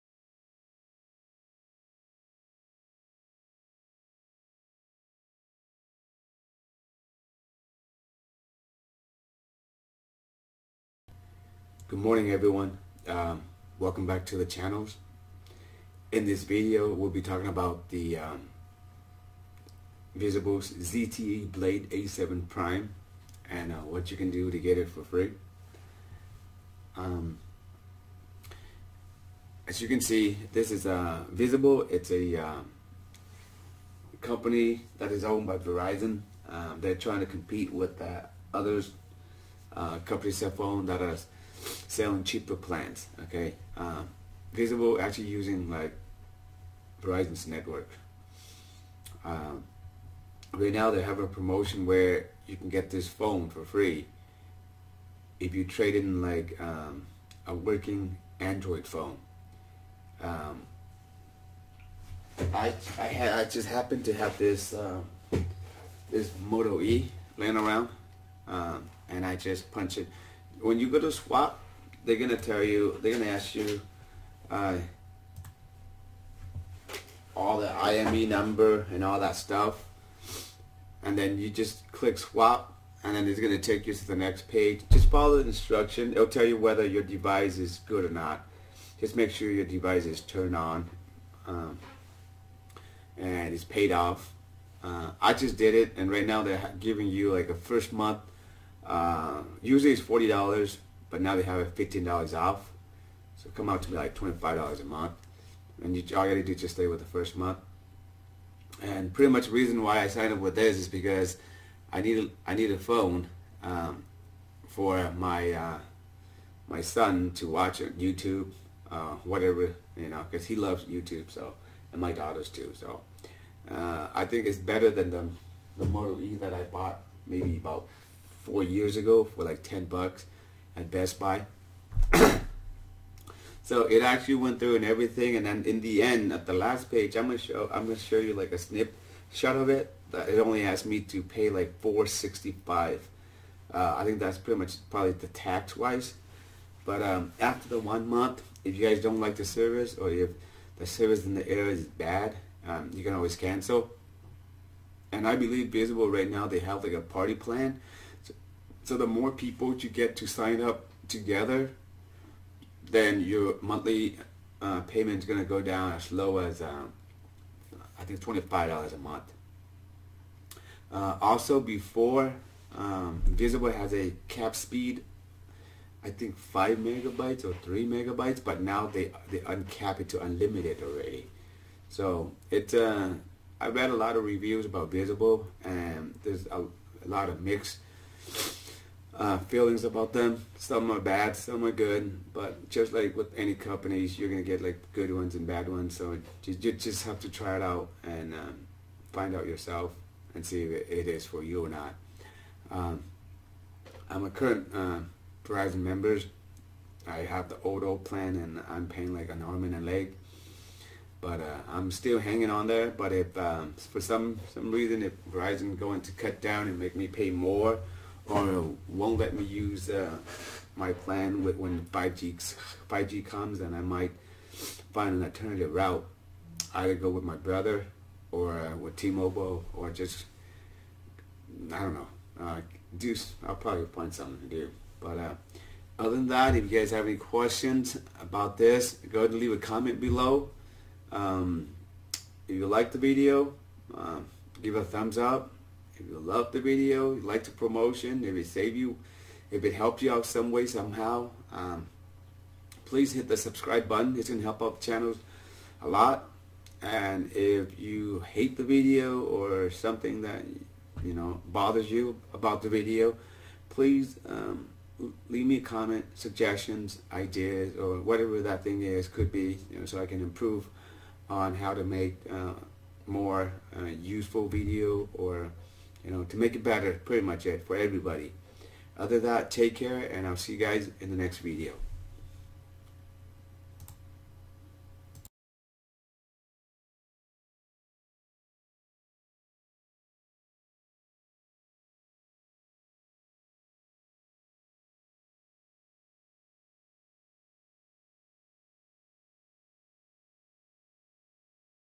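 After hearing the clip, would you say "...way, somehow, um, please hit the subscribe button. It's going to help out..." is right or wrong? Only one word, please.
right.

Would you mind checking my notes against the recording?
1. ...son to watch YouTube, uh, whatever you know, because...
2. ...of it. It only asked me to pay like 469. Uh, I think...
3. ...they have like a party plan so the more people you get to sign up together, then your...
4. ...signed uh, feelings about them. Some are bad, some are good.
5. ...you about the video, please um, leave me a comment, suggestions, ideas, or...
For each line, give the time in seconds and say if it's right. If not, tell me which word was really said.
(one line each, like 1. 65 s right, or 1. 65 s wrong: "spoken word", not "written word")
1. 116 s right
2. 139 s wrong: "465", not "469"
3. 156 s right
4. 187 s wrong: "mixed", not "signed"
5. 261 s right.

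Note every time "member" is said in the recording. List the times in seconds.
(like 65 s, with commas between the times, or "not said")
205 s.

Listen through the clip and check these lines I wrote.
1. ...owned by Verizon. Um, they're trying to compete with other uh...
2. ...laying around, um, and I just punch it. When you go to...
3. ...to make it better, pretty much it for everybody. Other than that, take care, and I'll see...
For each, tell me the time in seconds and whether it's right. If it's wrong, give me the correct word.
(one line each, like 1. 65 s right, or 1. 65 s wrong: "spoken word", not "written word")
1. 35 s right
2. 67 s right
3. 276 s right.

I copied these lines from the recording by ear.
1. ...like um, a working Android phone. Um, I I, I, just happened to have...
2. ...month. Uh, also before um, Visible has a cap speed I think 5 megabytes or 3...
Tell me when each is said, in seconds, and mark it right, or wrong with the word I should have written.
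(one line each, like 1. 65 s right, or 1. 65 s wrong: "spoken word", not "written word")
1. 56 s right
2. 168 s right.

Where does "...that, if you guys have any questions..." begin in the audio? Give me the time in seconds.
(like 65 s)
236 s.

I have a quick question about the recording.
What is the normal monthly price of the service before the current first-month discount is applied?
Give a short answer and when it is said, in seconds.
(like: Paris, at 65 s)
$40, at 100 s.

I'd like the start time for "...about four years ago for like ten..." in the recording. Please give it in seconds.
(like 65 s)
127 s.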